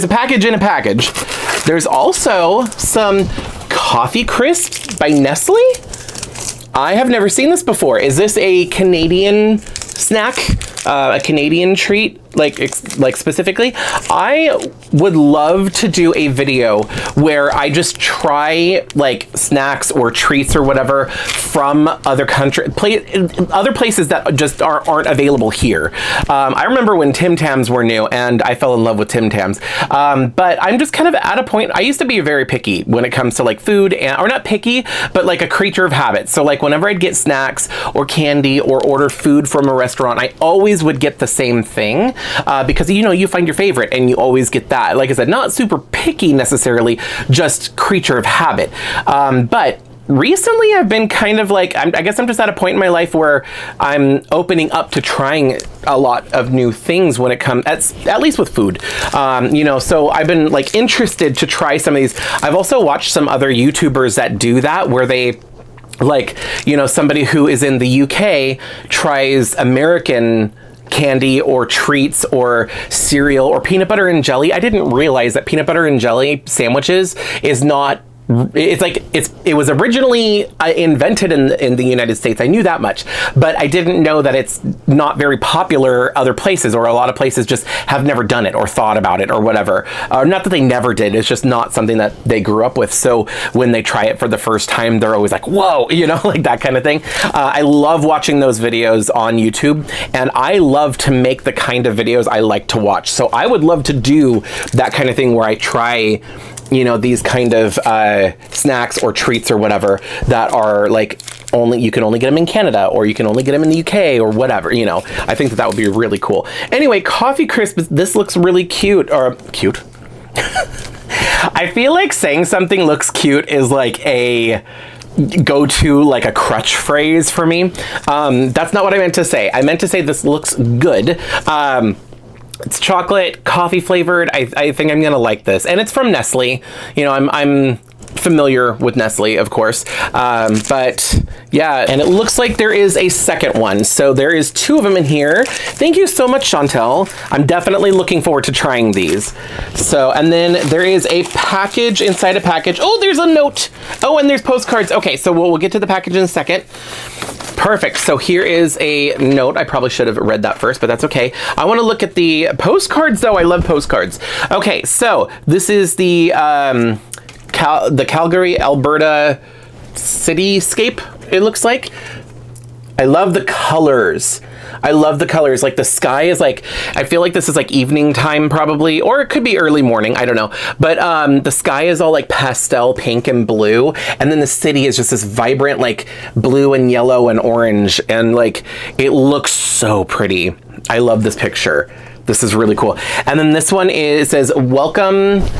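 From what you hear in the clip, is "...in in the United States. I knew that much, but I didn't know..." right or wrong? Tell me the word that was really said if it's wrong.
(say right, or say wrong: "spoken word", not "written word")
right.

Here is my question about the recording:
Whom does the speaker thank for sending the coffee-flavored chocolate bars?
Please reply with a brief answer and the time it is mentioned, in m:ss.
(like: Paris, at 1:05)
Chantel, at 2:26.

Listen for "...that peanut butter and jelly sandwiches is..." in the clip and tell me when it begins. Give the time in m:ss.
1:15.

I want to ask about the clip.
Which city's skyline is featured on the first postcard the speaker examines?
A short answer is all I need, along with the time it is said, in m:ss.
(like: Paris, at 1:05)
Calgary, Alberta, at 2:48.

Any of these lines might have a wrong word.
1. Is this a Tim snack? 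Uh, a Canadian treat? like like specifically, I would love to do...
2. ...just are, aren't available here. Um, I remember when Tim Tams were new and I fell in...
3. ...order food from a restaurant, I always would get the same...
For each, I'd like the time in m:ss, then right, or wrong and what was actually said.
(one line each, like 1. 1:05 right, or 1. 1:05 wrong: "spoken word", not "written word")
1. 0:07 wrong: "Canadian", not "Tim"
2. 0:24 right
3. 0:38 right.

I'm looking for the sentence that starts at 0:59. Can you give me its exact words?
Um, you know, so I've been like interested to try some of these.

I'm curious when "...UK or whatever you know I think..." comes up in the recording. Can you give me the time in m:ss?
1:53.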